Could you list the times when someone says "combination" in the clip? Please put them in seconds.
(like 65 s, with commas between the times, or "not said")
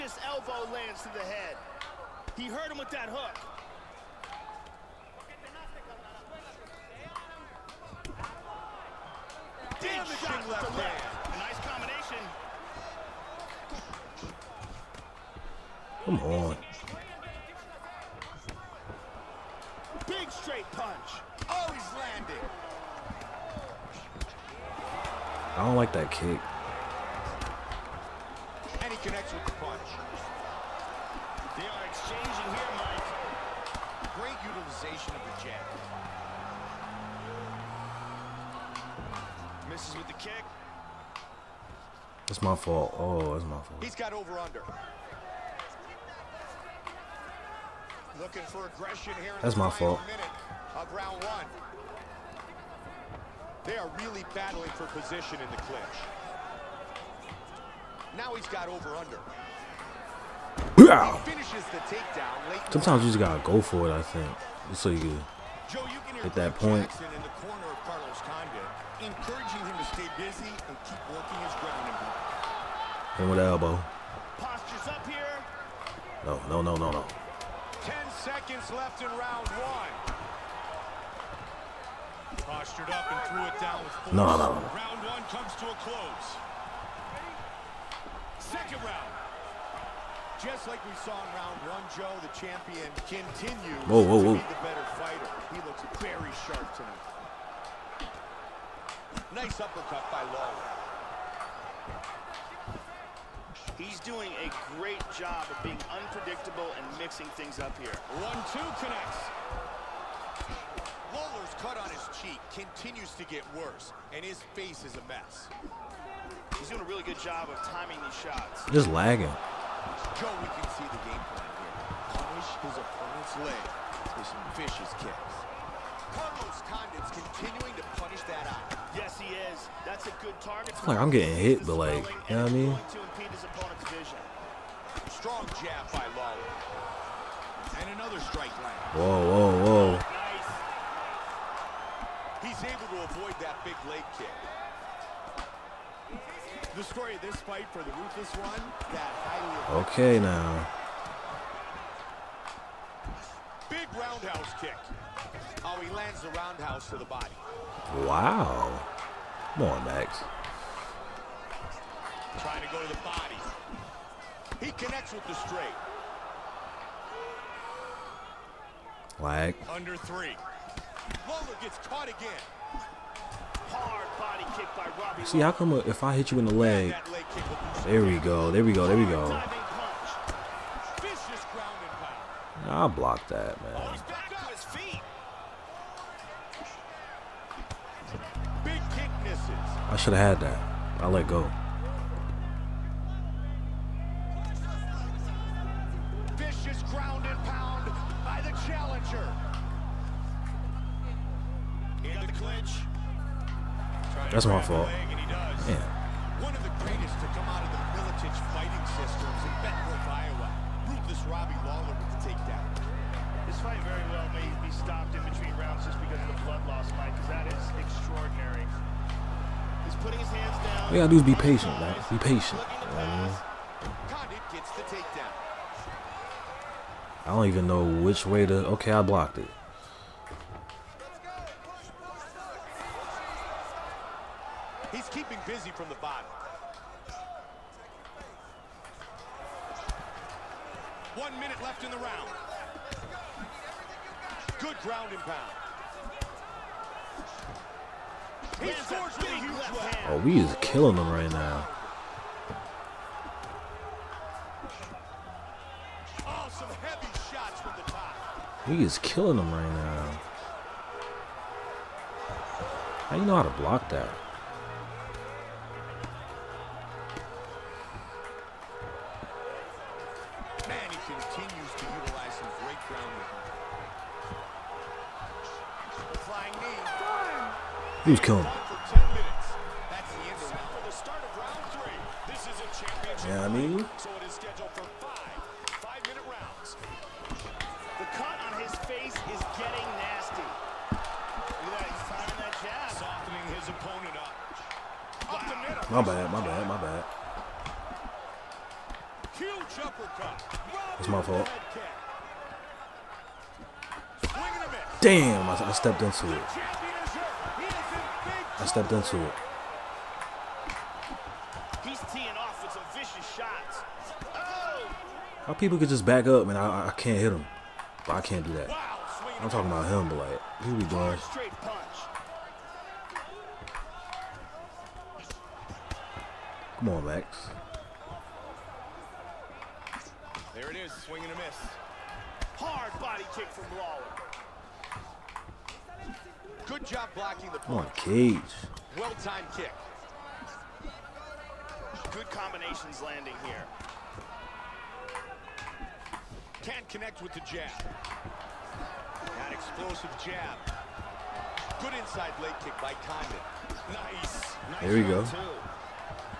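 11 s, 342 s.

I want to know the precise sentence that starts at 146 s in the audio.
The story of this fight for the ruthless one, that highly Okay now.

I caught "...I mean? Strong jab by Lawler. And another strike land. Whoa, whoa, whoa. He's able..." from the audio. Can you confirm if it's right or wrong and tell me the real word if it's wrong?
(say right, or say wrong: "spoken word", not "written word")
right.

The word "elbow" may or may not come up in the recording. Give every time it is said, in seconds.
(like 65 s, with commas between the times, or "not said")
0 s, 73 s.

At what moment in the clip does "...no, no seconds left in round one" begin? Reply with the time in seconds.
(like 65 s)
76 s.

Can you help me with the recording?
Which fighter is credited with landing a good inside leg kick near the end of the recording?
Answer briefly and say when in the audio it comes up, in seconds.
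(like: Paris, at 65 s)
Condit, at 353 s.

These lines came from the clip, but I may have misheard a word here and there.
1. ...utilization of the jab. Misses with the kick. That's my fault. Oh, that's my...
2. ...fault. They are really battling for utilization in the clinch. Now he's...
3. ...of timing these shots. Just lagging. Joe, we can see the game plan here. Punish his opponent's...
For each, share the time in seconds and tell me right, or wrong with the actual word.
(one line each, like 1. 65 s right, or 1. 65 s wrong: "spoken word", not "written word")
1. 34 s right
2. 49 s wrong: "position", not "utilization"
3. 117 s right.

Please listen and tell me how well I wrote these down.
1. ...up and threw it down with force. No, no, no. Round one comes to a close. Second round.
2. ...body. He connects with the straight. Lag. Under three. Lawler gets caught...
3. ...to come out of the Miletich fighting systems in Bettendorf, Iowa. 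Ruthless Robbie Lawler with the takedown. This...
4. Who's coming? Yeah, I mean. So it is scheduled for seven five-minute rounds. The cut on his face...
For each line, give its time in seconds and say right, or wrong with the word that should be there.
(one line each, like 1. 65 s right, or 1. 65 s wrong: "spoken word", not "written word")
1. 82 s right
2. 163 s right
3. 207 s right
4. 278 s wrong: "five", not "seven".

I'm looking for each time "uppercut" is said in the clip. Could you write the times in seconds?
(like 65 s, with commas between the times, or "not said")
99 s, 299 s.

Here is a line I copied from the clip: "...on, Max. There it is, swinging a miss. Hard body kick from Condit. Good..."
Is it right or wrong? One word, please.
wrong.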